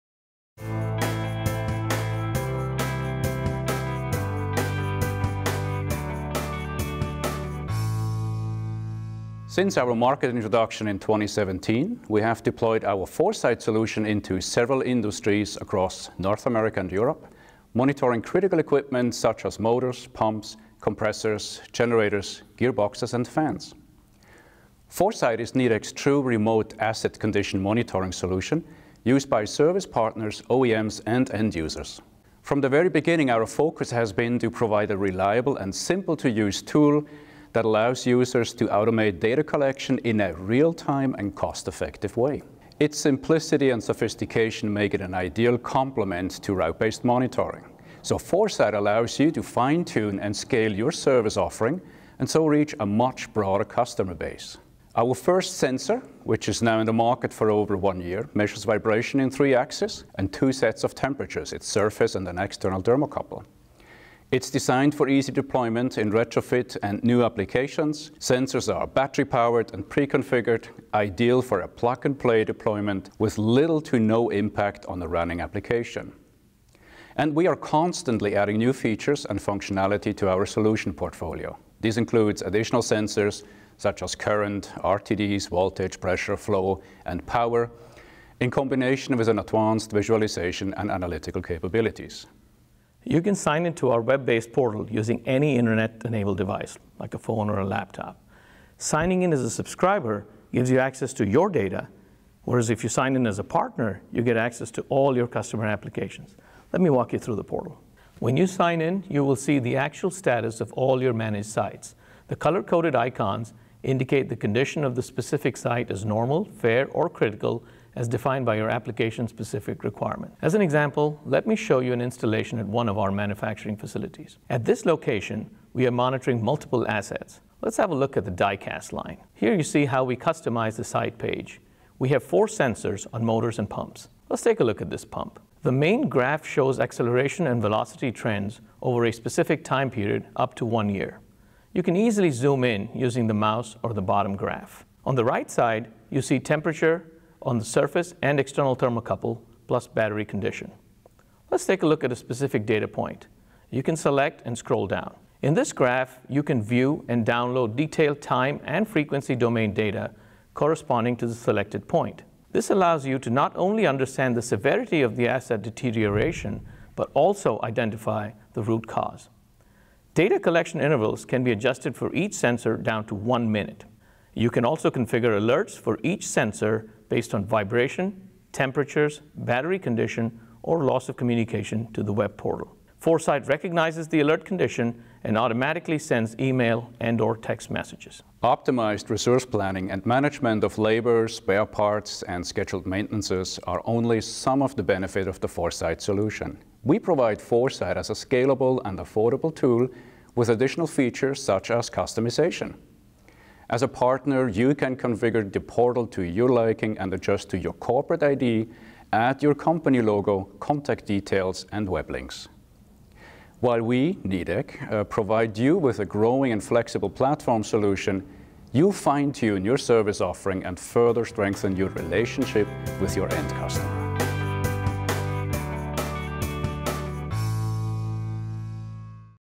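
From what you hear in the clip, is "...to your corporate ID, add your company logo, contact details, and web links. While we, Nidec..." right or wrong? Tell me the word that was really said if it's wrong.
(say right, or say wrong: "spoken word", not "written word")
right.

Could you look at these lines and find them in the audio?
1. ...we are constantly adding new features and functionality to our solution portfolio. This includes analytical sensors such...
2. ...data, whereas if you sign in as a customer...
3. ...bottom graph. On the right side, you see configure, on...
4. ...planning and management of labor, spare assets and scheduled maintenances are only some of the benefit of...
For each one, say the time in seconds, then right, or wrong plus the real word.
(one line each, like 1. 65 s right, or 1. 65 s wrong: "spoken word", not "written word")
1. 77 s wrong: "additional", not "analytical"
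2. 101 s wrong: "partner", not "customer"
3. 144 s wrong: "temperature", not "configure"
4. 189 s wrong: "parts", not "assets".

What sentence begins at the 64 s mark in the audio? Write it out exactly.
It's designed for easy deployment in retrofit and new applications.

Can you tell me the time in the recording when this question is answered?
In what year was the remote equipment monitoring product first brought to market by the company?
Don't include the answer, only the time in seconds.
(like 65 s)
10 s.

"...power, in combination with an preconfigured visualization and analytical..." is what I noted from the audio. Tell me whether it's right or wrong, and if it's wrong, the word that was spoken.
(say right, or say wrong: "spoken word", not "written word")
wrong: "advanced", not "preconfigured".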